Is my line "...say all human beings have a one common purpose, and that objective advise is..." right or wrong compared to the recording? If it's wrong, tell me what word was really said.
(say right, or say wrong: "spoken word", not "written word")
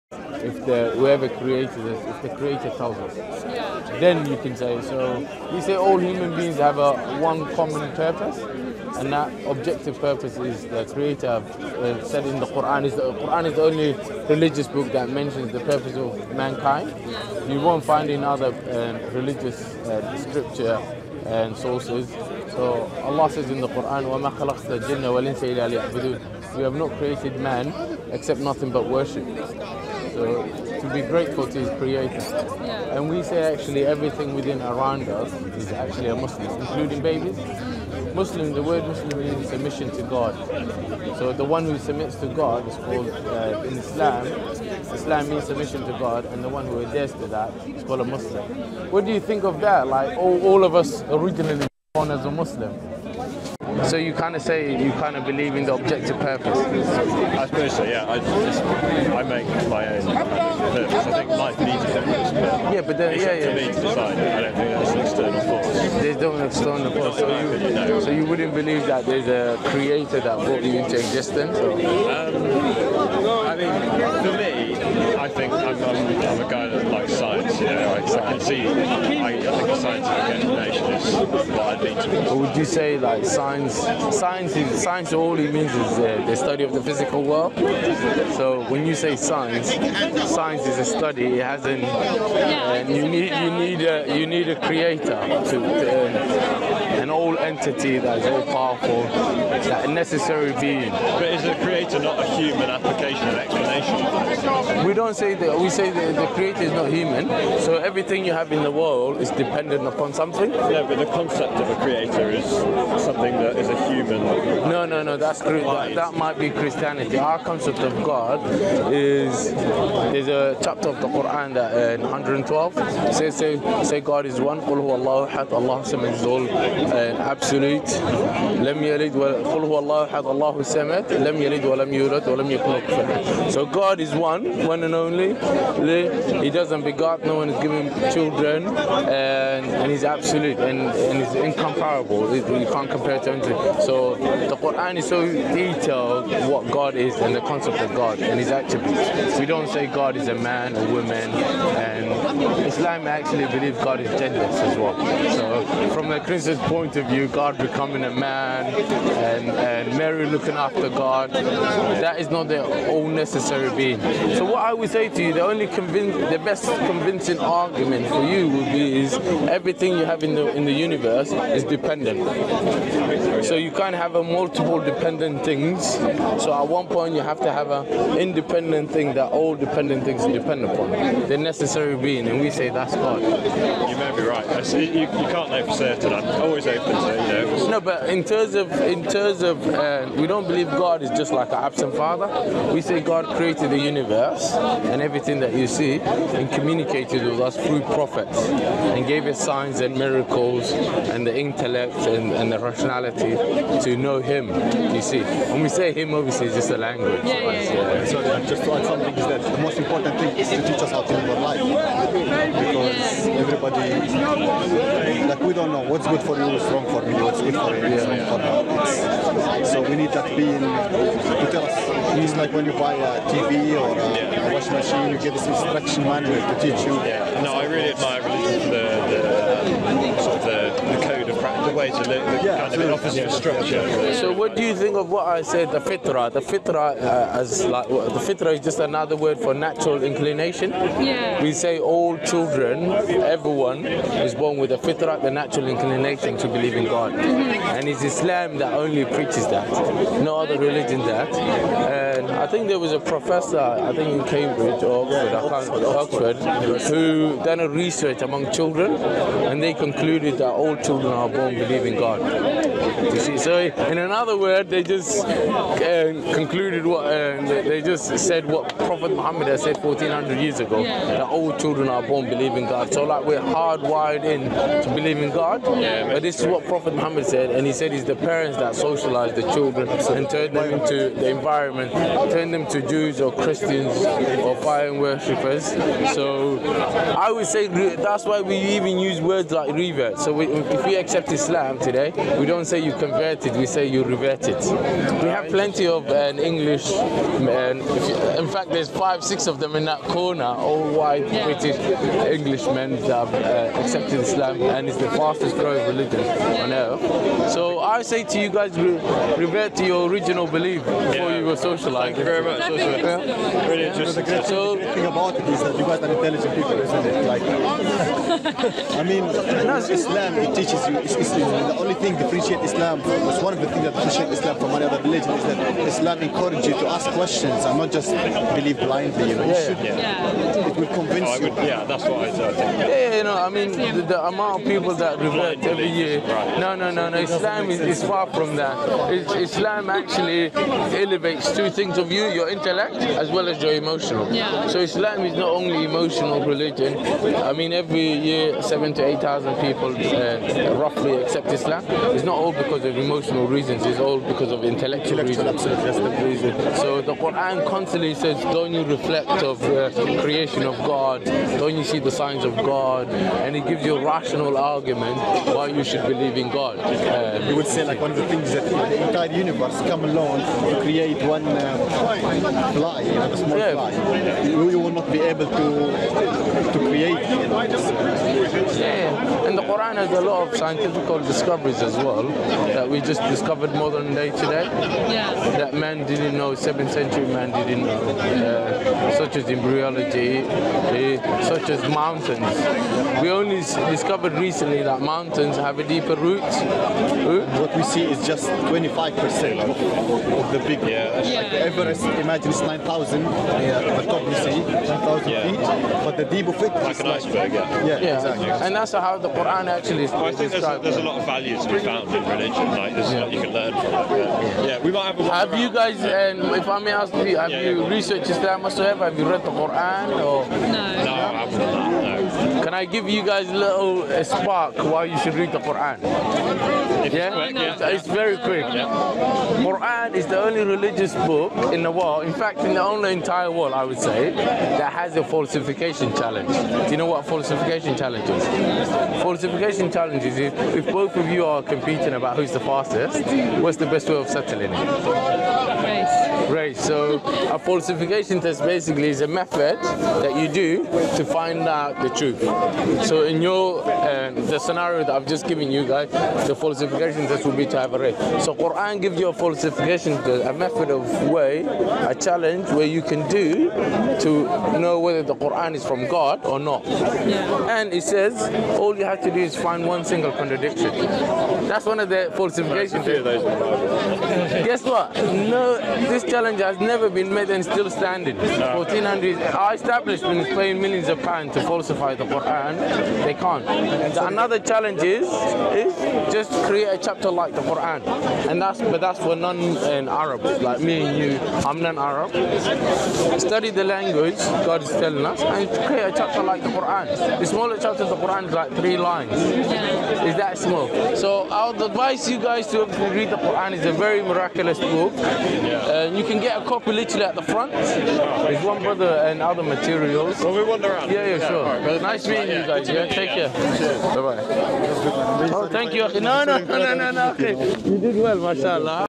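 wrong: "purpose", not "advise".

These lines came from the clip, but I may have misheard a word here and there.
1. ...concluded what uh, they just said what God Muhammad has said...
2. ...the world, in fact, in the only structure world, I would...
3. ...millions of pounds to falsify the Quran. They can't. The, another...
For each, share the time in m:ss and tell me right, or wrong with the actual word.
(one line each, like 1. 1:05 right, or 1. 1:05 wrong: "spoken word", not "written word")
1. 4:26 wrong: "Prophet", not "God"
2. 7:11 wrong: "entire", not "structure"
3. 8:00 right.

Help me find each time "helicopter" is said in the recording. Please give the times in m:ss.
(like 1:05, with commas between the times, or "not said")
not said.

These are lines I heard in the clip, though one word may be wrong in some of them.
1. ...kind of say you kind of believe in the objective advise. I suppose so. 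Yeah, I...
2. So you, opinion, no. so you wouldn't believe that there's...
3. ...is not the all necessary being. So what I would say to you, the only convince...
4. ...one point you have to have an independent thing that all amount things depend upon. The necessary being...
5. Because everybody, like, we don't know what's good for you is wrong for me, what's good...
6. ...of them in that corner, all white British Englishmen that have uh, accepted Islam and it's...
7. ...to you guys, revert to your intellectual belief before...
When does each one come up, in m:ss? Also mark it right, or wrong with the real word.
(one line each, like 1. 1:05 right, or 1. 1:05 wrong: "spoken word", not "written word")
1. 0:54 wrong: "purpose", not "advise"
2. 1:07 right
3. 2:42 right
4. 2:56 wrong: "dependent", not "amount"
5. 3:32 right
6. 4:59 right
7. 5:08 wrong: "original", not "intellectual".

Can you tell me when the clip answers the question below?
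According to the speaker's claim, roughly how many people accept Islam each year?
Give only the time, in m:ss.
5:48.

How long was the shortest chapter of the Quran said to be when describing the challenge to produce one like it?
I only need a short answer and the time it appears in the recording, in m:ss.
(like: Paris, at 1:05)
3 lines, at 8:18.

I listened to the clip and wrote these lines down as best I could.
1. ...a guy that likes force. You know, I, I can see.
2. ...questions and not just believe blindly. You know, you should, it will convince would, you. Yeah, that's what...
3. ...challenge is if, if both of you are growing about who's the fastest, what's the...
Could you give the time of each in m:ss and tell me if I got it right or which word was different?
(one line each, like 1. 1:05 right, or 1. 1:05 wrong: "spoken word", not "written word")
1. 1:16 wrong: "science", not "force"
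2. 5:27 right
3. 7:19 wrong: "competing", not "growing".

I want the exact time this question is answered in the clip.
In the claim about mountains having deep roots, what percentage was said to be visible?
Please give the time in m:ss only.
6:38.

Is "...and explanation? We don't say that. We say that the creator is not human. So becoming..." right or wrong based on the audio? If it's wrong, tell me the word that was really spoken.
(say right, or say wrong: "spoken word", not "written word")
wrong: "everything", not "becoming".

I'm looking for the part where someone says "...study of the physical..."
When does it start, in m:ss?
1:26.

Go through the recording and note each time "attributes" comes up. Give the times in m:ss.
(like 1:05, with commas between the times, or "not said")
2:28.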